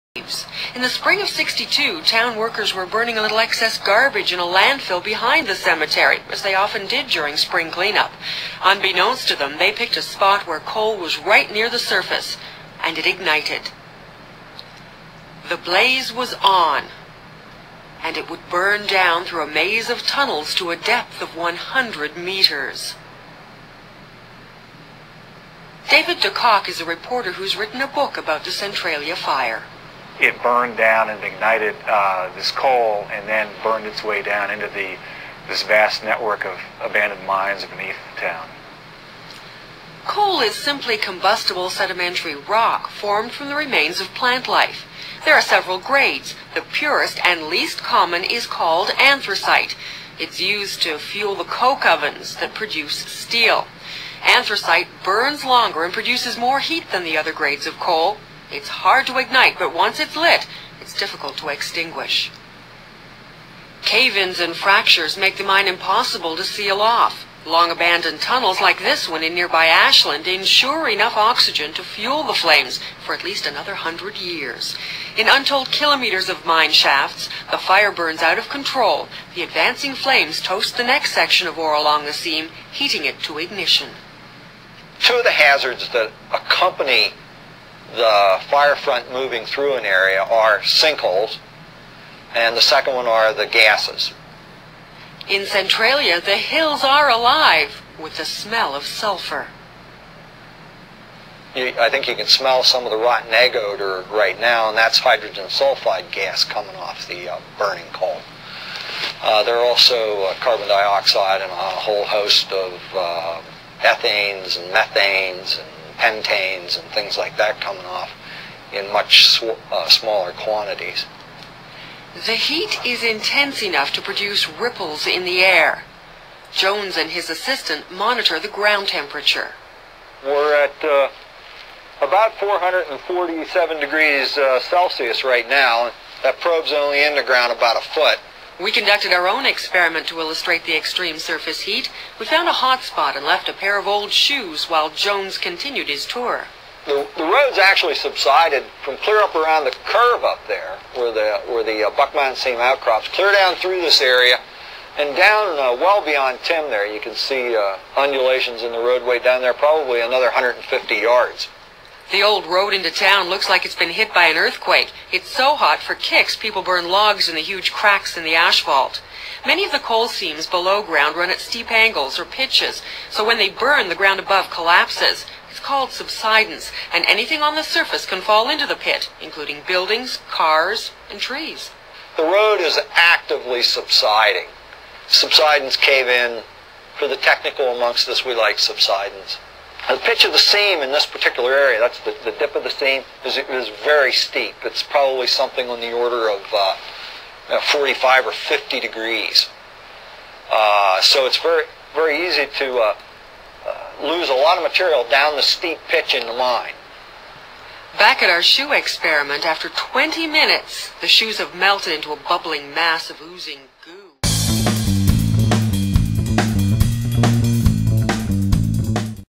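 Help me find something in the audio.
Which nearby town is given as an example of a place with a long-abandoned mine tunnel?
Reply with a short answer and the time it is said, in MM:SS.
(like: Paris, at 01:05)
Ashland, at 01:09.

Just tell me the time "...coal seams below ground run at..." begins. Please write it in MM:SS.
02:49.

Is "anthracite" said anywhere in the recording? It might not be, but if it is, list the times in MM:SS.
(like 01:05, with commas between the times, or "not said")
00:48, 00:54.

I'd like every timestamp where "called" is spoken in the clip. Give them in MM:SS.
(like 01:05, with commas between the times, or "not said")
00:48, 02:55.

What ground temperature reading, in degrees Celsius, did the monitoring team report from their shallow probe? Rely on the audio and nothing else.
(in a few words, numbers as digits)
447.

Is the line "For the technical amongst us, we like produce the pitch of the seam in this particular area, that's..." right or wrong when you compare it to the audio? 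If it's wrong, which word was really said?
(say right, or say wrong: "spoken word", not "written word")
wrong: "subsidence", not "produce".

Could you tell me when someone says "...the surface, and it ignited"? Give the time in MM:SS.
00:11.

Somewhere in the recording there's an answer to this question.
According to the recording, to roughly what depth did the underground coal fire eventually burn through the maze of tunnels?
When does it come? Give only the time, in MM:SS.
00:21.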